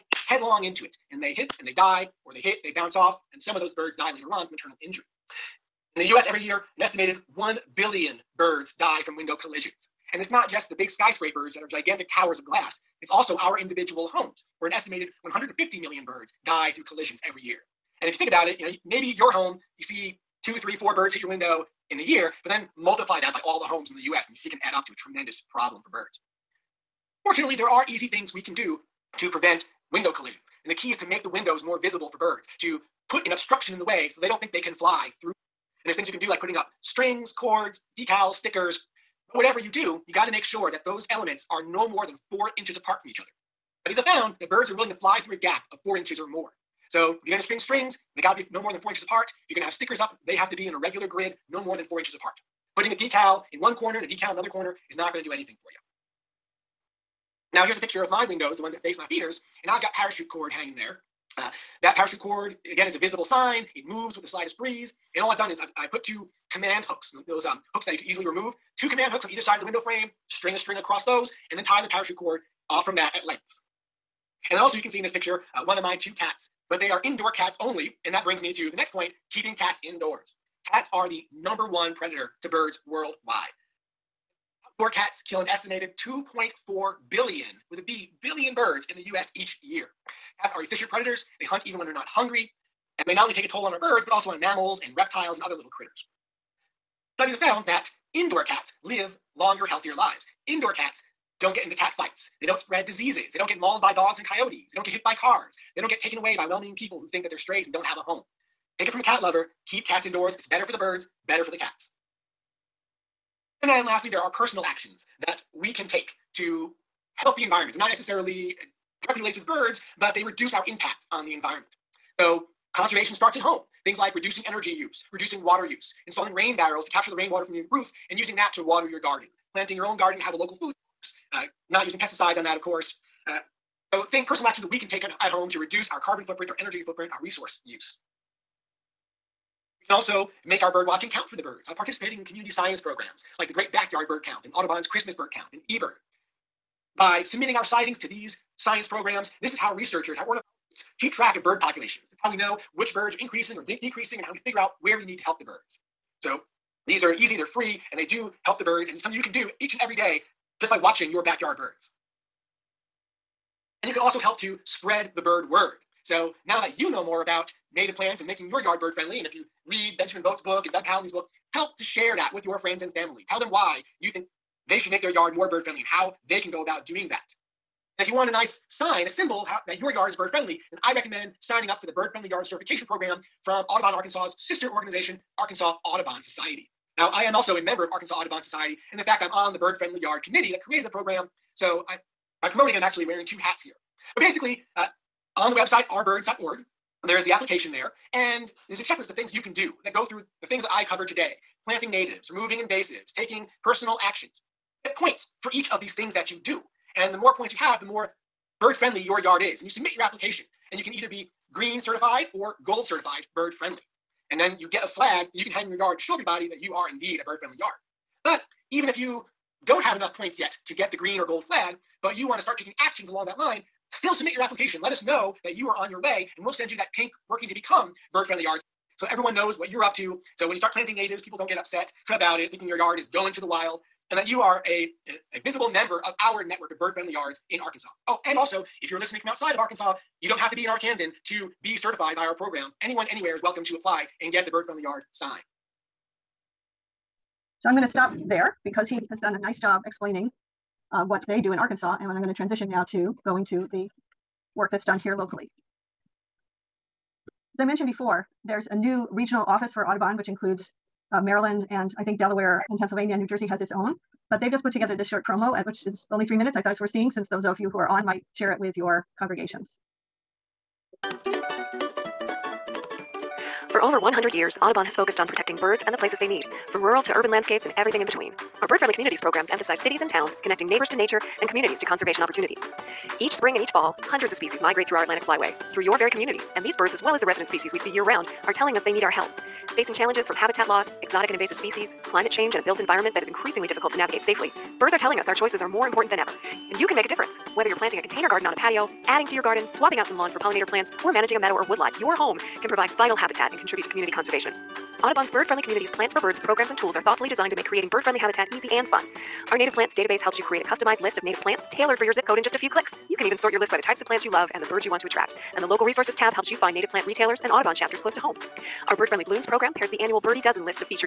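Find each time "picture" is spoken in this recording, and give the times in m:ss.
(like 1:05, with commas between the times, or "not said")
0:57, 1:15.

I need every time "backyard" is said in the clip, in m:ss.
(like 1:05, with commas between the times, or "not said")
2:23, 2:41.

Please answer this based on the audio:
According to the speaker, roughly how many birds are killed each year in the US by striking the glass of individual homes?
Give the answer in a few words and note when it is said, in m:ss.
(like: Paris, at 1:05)
150 million, at 0:15.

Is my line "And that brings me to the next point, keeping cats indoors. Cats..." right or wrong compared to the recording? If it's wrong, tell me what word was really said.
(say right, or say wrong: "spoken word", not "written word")
right.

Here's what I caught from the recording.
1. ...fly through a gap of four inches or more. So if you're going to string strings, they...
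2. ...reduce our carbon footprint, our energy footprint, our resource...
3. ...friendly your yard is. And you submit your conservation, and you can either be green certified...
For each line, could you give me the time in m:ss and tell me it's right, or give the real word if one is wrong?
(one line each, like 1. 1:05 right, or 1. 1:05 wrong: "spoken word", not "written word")
1. 0:44 right
2. 2:15 right
3. 3:28 wrong: "application", not "conservation".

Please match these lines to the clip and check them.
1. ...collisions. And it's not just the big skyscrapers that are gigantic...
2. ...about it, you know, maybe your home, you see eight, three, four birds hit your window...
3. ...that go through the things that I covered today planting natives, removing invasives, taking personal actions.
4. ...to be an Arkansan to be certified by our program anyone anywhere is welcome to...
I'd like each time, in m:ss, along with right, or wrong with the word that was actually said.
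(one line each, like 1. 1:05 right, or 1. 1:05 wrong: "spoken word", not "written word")
1. 0:09 right
2. 0:18 wrong: "two", not "eight"
3. 3:19 right
4. 4:00 right.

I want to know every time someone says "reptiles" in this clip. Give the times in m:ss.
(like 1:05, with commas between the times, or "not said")
1:34.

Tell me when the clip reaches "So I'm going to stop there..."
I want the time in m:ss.
4:07.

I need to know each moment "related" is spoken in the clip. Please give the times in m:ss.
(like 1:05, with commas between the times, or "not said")
1:59.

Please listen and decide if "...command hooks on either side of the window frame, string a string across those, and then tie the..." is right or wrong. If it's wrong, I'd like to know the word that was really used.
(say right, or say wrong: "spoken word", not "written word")
right.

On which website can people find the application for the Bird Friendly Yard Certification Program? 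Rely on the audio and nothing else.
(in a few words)
arbirds.org.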